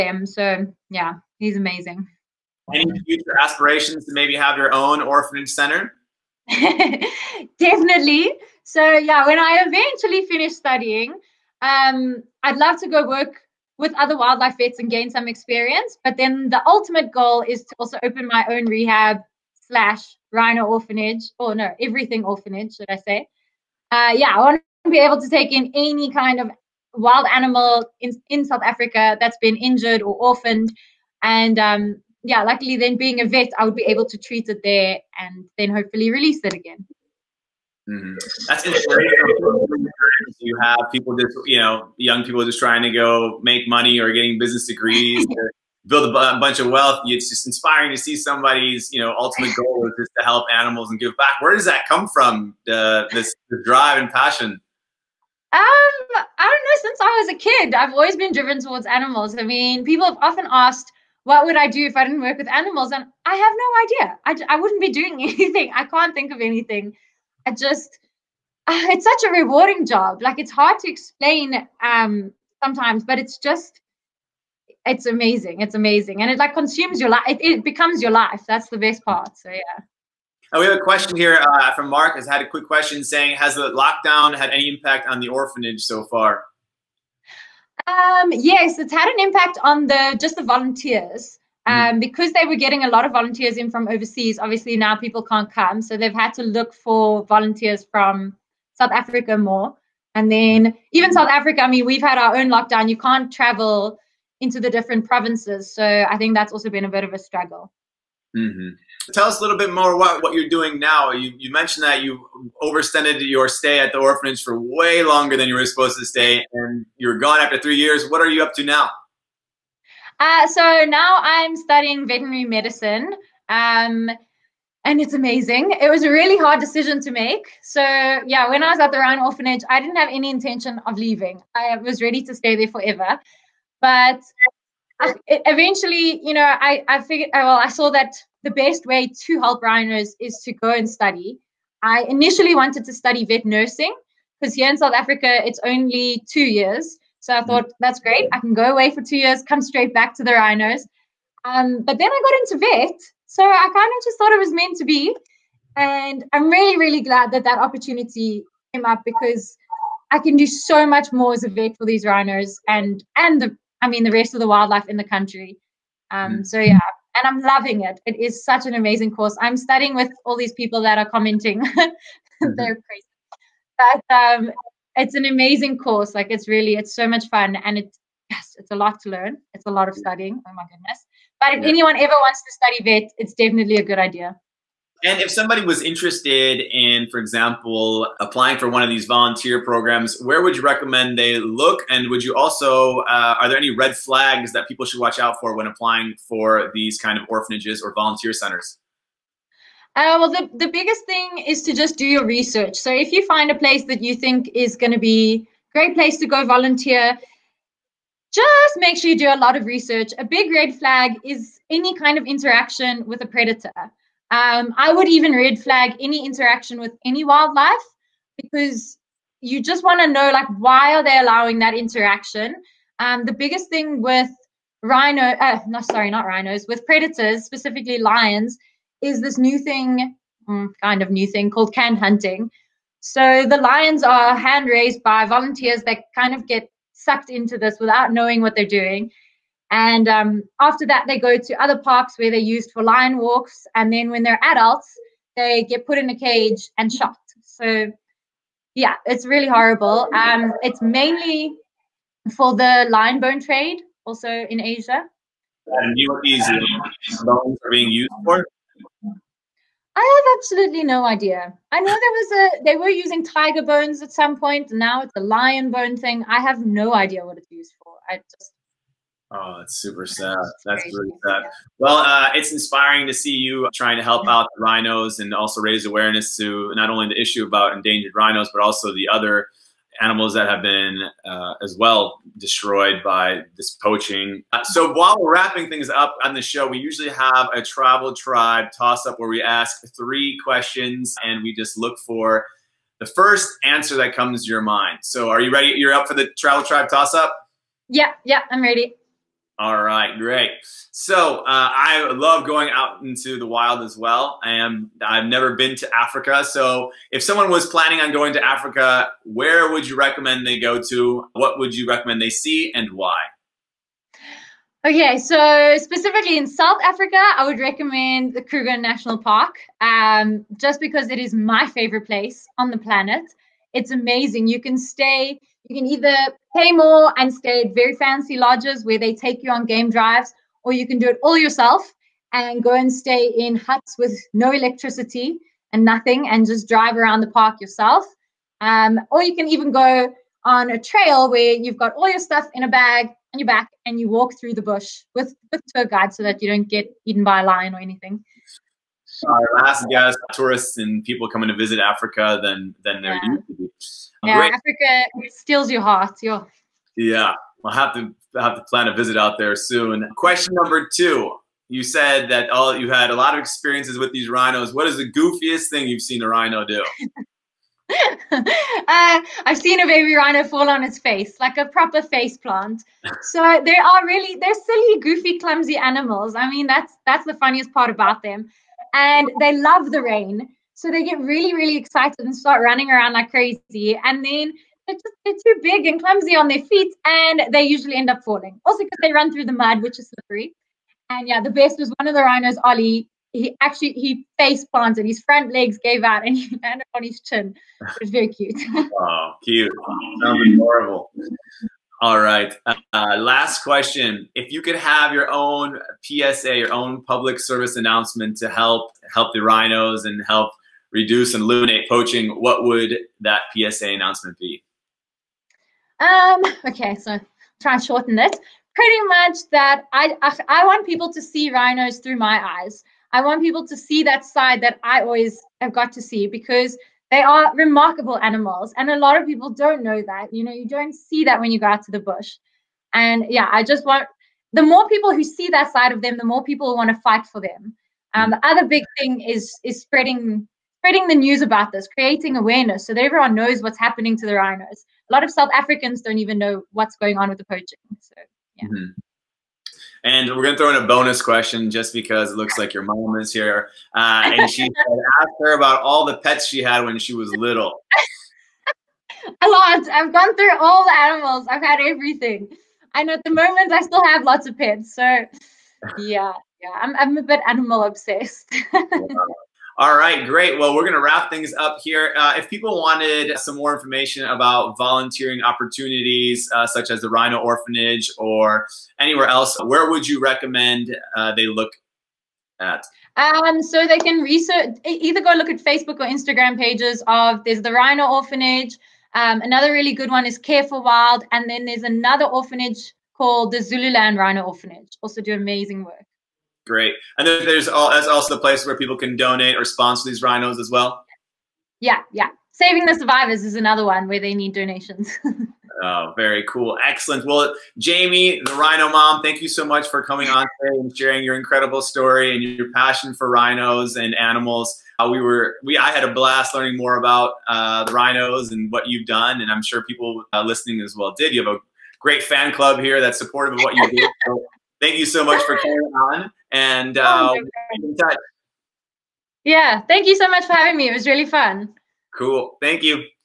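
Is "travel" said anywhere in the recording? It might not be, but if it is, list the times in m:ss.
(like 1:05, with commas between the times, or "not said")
1:43, 4:47, 4:56.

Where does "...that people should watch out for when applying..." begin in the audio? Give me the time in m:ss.
3:14.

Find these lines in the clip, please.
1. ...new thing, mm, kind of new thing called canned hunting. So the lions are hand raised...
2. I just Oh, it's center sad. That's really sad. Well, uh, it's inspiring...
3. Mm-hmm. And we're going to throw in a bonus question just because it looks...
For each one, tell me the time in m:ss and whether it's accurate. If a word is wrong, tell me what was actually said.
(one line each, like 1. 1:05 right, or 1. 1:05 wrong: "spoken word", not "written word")
1. 3:49 right
2. 4:28 wrong: "super", not "center"
3. 7:28 right.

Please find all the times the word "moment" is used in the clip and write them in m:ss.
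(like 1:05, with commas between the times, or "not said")
7:43.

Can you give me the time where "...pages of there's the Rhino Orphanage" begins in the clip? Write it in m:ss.
8:06.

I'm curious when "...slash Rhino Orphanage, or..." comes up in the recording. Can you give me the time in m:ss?
0:19.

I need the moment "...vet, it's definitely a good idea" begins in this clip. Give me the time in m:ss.
3:02.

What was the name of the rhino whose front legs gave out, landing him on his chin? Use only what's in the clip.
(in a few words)
Ollie.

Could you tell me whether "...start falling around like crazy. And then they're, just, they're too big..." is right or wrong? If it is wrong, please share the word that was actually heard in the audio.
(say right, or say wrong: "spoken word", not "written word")
wrong: "running", not "falling".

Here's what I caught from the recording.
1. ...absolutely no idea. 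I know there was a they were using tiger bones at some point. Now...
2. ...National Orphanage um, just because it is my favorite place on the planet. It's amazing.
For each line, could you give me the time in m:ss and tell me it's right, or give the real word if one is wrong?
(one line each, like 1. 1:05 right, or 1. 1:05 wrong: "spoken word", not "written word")
1. 4:20 right
2. 5:18 wrong: "Park", not "Orphanage".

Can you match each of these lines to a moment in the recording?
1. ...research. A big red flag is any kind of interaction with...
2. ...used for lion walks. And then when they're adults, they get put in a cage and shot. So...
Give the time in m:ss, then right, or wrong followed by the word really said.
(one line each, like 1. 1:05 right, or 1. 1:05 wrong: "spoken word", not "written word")
1. 3:29 right
2. 4:02 right.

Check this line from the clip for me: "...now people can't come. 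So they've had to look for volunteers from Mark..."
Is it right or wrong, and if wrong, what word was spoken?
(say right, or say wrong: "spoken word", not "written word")
wrong: "South", not "Mark".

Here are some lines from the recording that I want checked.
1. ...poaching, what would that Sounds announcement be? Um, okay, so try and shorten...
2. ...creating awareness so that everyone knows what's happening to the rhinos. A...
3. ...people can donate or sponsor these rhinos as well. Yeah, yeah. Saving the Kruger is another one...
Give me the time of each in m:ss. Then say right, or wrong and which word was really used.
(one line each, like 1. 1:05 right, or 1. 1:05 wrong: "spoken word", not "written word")
1. 6:51 wrong: "PSA", not "Sounds"
2. 7:21 right
3. 8:18 wrong: "Survivors", not "Kruger".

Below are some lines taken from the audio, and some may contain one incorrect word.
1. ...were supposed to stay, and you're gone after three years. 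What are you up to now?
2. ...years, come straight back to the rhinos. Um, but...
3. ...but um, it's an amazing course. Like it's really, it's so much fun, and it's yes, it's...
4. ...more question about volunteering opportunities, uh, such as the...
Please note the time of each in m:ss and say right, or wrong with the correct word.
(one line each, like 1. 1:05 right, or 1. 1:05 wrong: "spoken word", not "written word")
1. 1:55 right
2. 2:29 right
3. 2:54 right
4. 7:53 wrong: "information", not "question".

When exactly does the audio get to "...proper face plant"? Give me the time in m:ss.
6:11.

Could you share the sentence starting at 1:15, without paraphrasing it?
It's amazing, and it like consumes your life.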